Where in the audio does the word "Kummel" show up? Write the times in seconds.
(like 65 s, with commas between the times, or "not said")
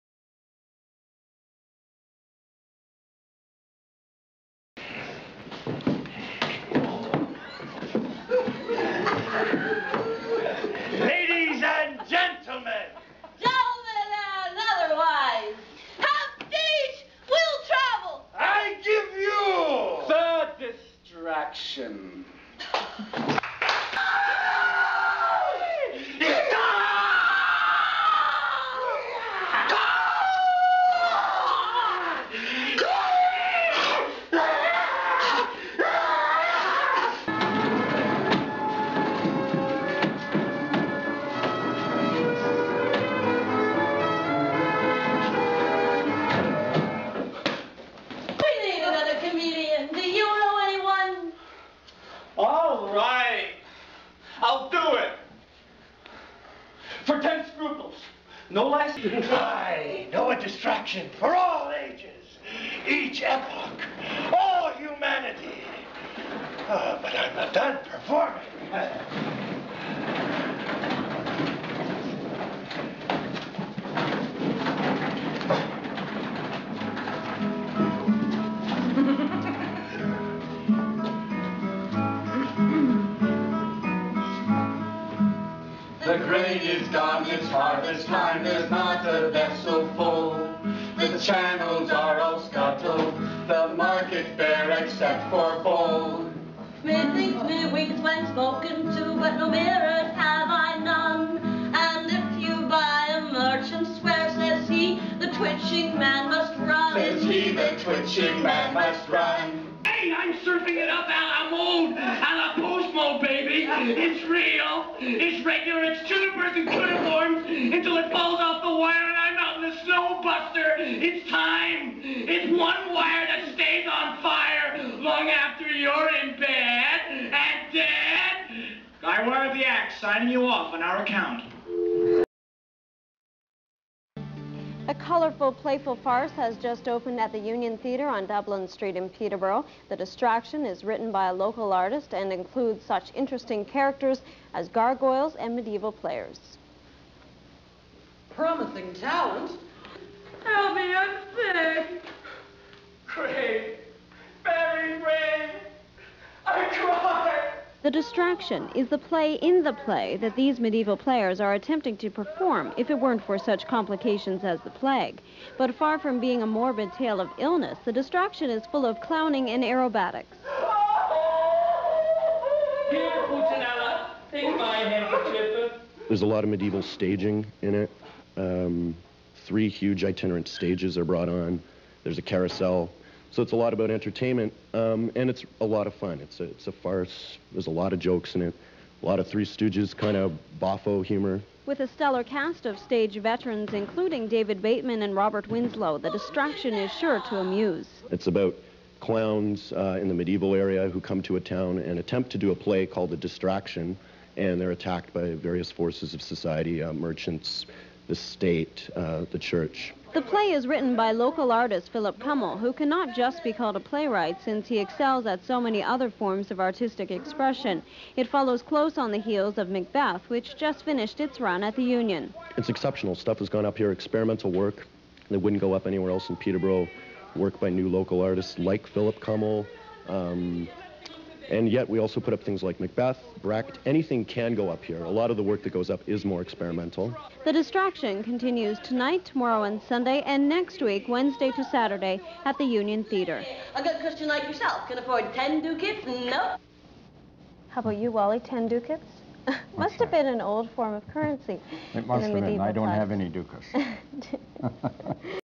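212 s, 229 s.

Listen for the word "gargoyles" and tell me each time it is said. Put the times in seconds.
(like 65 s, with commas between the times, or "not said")
144 s.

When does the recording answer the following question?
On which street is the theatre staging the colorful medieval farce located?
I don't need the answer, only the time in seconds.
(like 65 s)
138 s.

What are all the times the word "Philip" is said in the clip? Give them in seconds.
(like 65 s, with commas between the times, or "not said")
211 s, 228 s.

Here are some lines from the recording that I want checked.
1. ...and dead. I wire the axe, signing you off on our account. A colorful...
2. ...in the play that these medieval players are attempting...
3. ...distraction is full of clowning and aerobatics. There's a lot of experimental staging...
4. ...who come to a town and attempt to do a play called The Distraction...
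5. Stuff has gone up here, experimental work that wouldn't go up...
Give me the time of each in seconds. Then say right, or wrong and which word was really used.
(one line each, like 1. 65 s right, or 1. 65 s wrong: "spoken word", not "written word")
1. 127 s right
2. 159 s right
3. 167 s wrong: "medieval", not "experimental"
4. 200 s right
5. 223 s right.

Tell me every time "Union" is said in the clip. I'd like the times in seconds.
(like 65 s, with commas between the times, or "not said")
137 s, 221 s, 242 s.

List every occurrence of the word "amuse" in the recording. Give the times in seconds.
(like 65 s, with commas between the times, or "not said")
197 s.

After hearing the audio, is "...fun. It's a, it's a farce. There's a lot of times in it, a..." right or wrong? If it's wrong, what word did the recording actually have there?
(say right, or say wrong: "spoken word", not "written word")
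wrong: "jokes", not "times".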